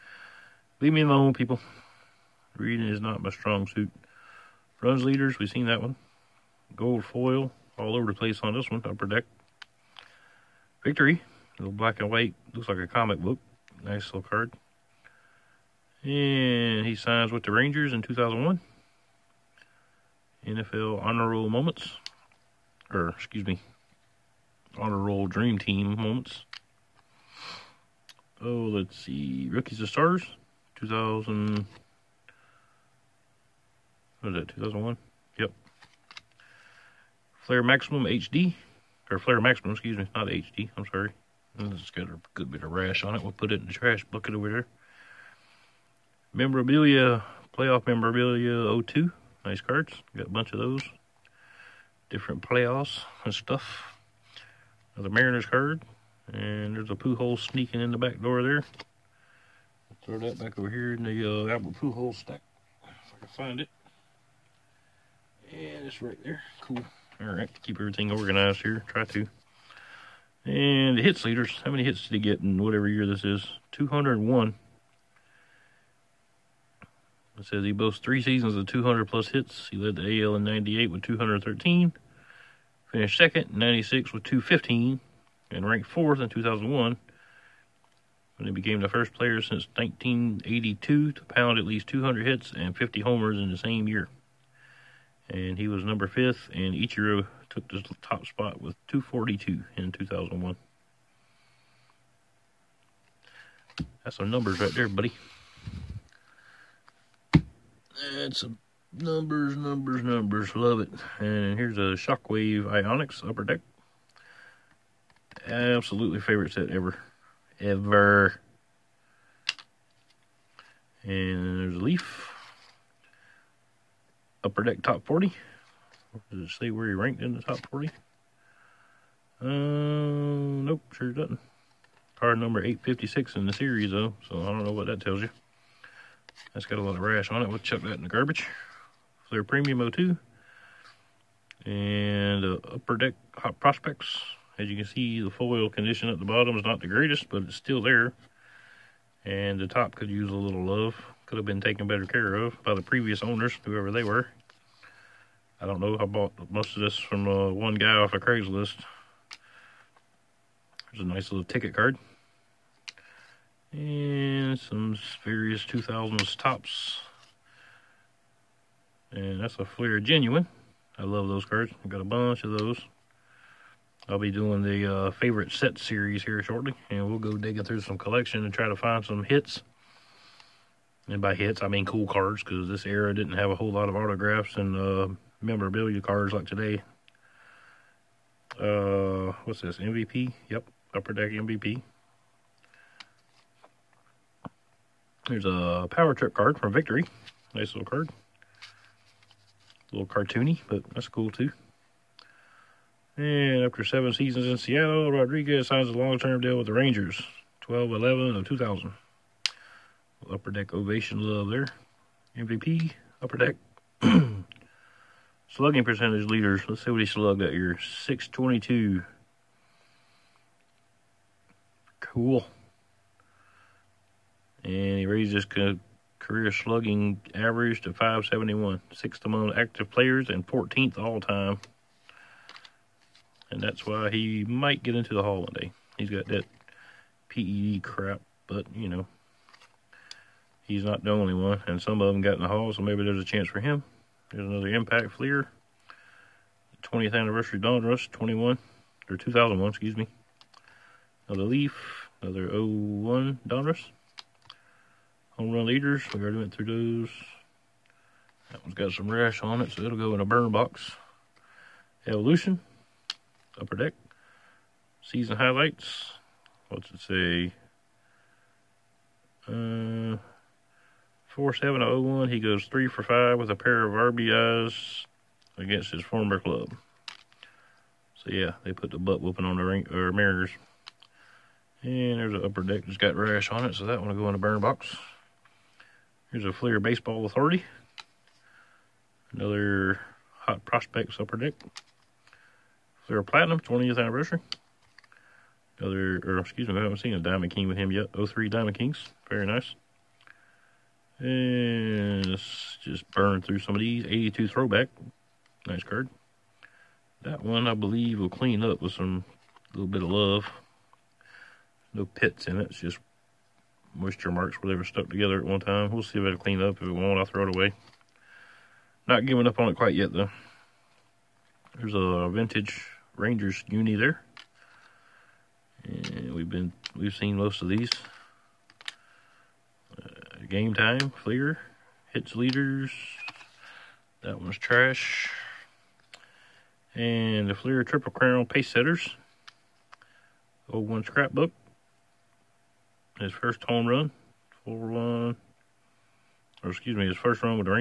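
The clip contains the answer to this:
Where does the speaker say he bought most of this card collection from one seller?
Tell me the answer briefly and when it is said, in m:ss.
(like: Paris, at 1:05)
Craigslist, at 2:38.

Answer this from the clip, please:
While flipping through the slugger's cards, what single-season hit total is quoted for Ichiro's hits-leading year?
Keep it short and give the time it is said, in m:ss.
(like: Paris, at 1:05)
242, at 1:38.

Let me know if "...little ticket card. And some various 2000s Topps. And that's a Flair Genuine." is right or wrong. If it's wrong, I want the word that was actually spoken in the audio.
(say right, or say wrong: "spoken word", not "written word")
right.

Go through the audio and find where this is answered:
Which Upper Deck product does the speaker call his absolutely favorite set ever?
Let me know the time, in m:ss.
1:52.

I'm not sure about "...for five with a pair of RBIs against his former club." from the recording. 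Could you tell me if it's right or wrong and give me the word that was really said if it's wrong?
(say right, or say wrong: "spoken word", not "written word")
right.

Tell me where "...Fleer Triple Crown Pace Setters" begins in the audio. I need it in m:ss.
5:37.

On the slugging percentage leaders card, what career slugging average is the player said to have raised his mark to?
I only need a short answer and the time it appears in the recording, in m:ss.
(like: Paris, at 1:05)
571, at 3:47.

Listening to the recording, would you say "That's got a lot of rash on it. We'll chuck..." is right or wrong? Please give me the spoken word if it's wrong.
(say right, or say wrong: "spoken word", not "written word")
right.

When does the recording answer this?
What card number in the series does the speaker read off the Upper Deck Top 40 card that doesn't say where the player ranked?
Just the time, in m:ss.
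2:12.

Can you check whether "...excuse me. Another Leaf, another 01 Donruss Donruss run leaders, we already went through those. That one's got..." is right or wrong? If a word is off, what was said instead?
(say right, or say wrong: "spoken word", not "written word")
wrong: "Home", not "Donruss".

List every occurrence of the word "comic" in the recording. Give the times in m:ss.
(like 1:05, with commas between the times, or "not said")
0:12.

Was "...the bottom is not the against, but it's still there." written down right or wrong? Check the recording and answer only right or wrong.
wrong.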